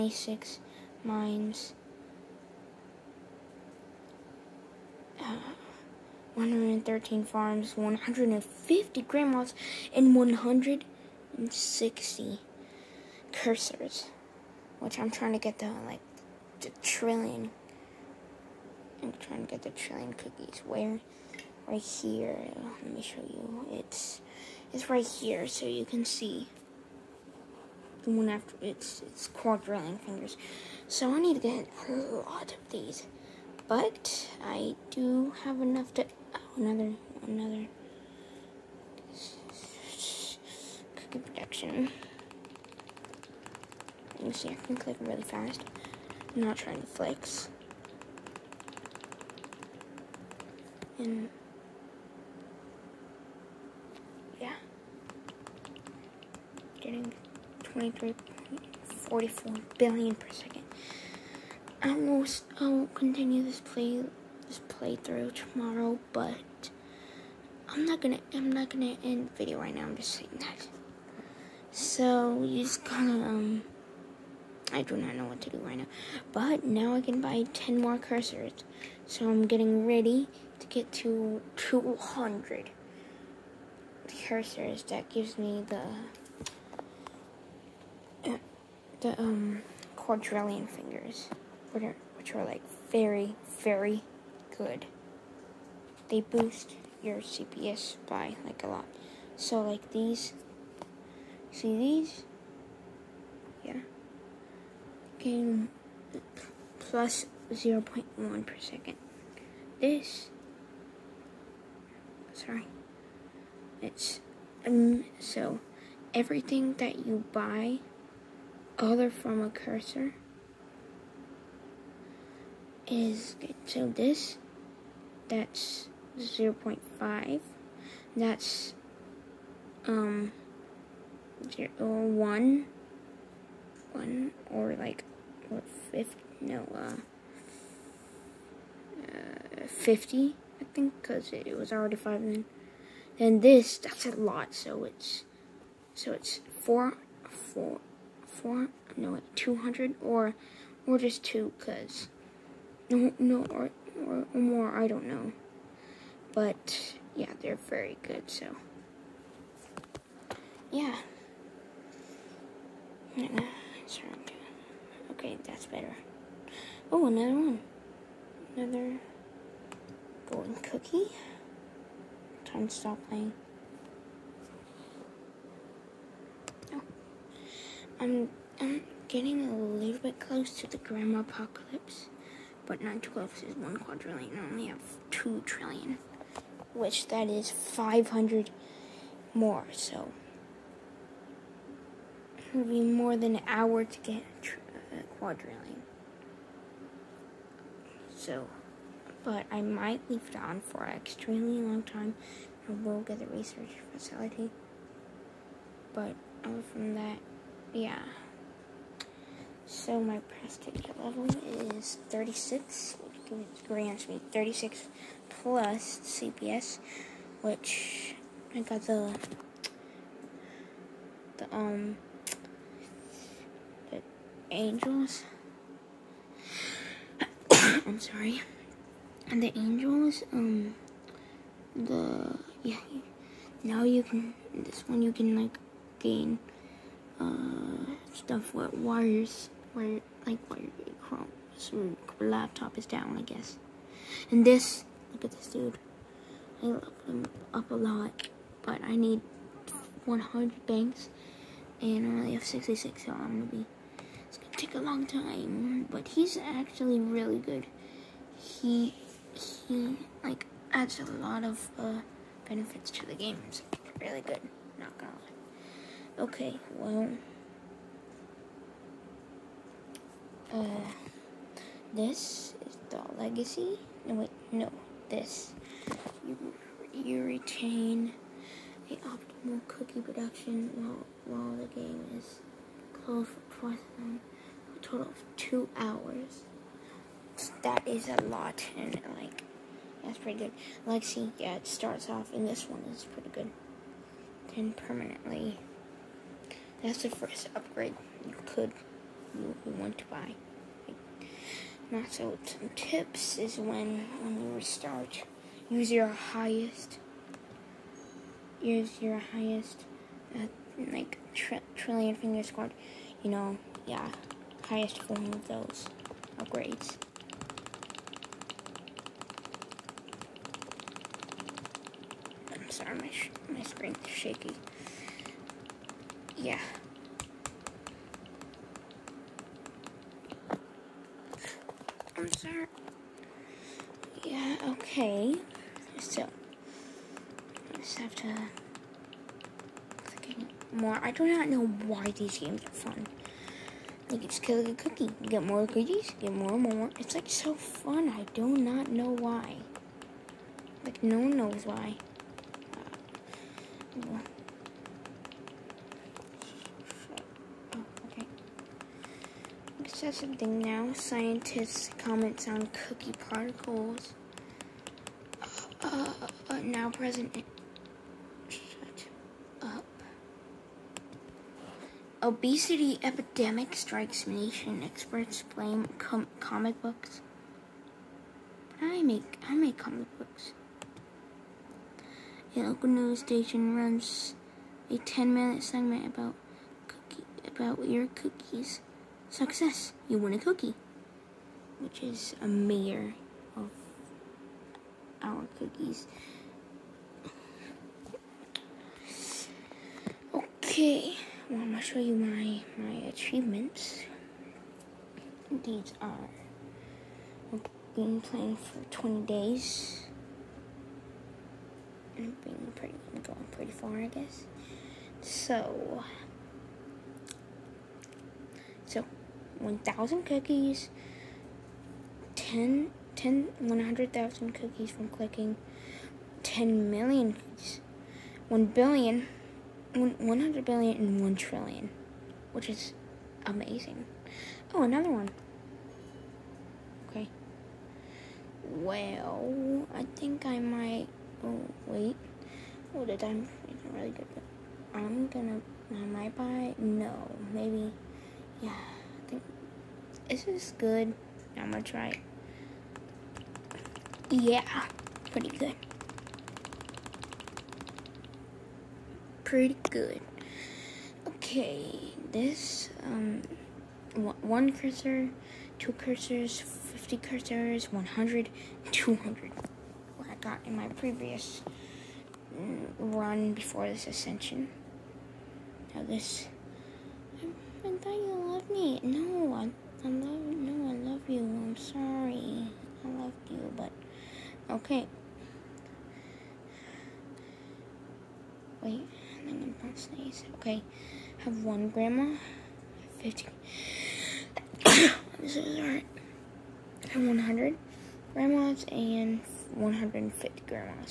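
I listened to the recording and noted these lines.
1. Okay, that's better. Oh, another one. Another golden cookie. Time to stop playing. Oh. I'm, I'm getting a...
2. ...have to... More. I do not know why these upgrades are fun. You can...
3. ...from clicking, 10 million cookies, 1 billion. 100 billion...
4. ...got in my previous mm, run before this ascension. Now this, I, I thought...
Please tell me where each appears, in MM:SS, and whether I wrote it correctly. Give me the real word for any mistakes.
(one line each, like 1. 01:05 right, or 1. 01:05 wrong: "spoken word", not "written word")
1. 02:45 right
2. 05:37 wrong: "games", not "upgrades"
3. 07:04 right
4. 07:50 right.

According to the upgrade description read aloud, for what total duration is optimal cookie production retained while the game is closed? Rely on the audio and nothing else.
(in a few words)
two hours.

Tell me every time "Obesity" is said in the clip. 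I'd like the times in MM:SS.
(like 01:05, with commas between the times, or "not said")
06:12.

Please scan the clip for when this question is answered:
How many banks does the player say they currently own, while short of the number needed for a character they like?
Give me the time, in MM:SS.
04:12.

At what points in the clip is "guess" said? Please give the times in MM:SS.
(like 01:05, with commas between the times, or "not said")
04:03, 06:54.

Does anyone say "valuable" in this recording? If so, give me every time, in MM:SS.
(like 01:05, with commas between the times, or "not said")
not said.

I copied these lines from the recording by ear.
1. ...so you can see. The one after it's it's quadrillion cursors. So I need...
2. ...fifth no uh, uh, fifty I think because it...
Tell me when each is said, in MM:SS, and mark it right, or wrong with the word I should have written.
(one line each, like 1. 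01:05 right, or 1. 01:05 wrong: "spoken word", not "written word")
1. 00:25 wrong: "fingers", not "cursors"
2. 02:15 right.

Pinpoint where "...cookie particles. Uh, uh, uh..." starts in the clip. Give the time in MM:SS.
06:02.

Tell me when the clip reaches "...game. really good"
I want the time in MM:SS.
04:23.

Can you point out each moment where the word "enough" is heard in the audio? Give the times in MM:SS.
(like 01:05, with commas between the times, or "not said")
00:35.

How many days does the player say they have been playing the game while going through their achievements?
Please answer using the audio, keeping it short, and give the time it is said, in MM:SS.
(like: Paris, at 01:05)
20 days, at 06:48.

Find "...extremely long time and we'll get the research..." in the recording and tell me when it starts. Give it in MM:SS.
03:20.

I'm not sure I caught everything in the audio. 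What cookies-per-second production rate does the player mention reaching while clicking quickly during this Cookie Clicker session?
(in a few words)
23.44 billion per second.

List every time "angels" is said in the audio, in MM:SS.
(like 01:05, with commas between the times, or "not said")
03:44, 03:49.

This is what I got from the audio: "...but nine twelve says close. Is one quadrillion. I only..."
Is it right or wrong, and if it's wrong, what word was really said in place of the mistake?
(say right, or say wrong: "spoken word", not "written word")
right.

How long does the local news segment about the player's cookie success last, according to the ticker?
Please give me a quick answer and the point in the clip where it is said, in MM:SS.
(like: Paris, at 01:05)
10 minutes, at 06:24.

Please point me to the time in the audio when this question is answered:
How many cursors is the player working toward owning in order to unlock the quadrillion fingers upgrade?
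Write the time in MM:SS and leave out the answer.
01:21.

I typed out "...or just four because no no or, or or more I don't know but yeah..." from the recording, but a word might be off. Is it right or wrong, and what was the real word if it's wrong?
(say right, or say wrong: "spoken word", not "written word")
wrong: "two", not "four".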